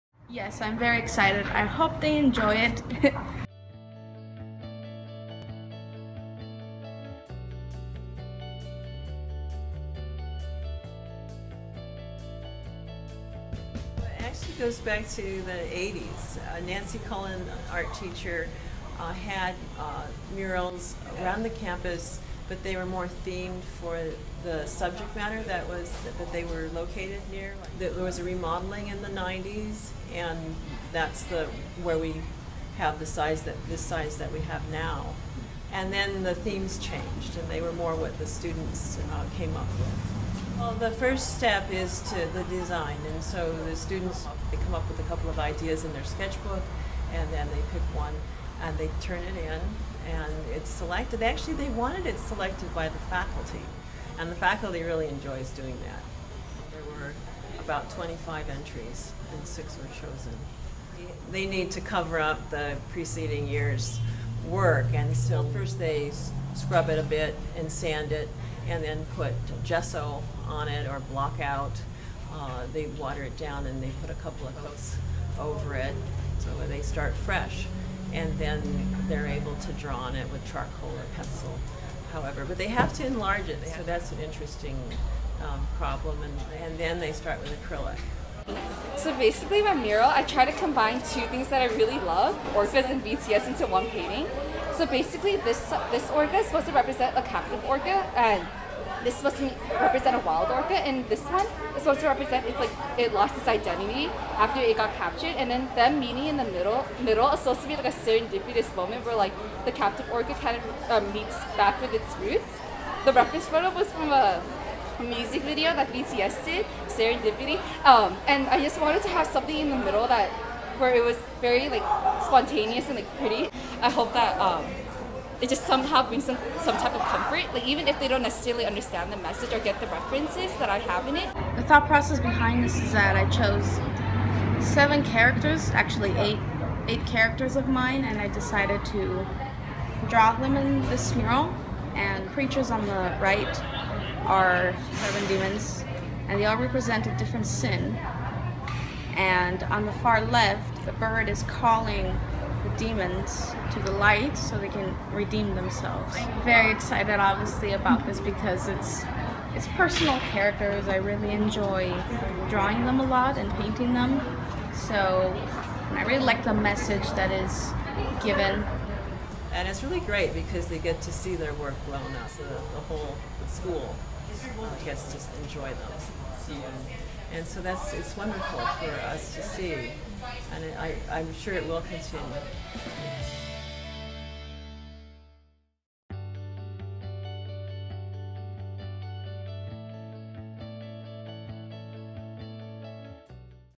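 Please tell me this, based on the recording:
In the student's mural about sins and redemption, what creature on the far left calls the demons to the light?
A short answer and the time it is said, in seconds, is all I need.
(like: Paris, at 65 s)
The bird, at 150 s.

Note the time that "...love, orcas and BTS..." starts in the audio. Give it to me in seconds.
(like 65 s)
91 s.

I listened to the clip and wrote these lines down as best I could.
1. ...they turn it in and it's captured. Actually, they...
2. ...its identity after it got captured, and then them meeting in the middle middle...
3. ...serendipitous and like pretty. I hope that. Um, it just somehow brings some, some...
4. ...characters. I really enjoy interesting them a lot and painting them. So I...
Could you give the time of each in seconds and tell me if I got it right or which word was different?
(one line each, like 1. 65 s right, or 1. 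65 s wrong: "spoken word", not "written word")
1. 48 s wrong: "selected", not "captured"
2. 103 s right
3. 122 s wrong: "spontaneous", not "serendipitous"
4. 160 s wrong: "drawing", not "interesting".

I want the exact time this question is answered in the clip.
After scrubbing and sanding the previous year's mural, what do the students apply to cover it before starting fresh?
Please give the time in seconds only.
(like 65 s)
69 s.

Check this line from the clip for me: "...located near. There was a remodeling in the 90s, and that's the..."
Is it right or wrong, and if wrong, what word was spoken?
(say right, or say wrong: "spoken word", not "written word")
right.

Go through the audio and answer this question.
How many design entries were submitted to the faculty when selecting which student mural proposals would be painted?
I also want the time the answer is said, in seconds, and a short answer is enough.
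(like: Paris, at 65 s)
25, at 57 s.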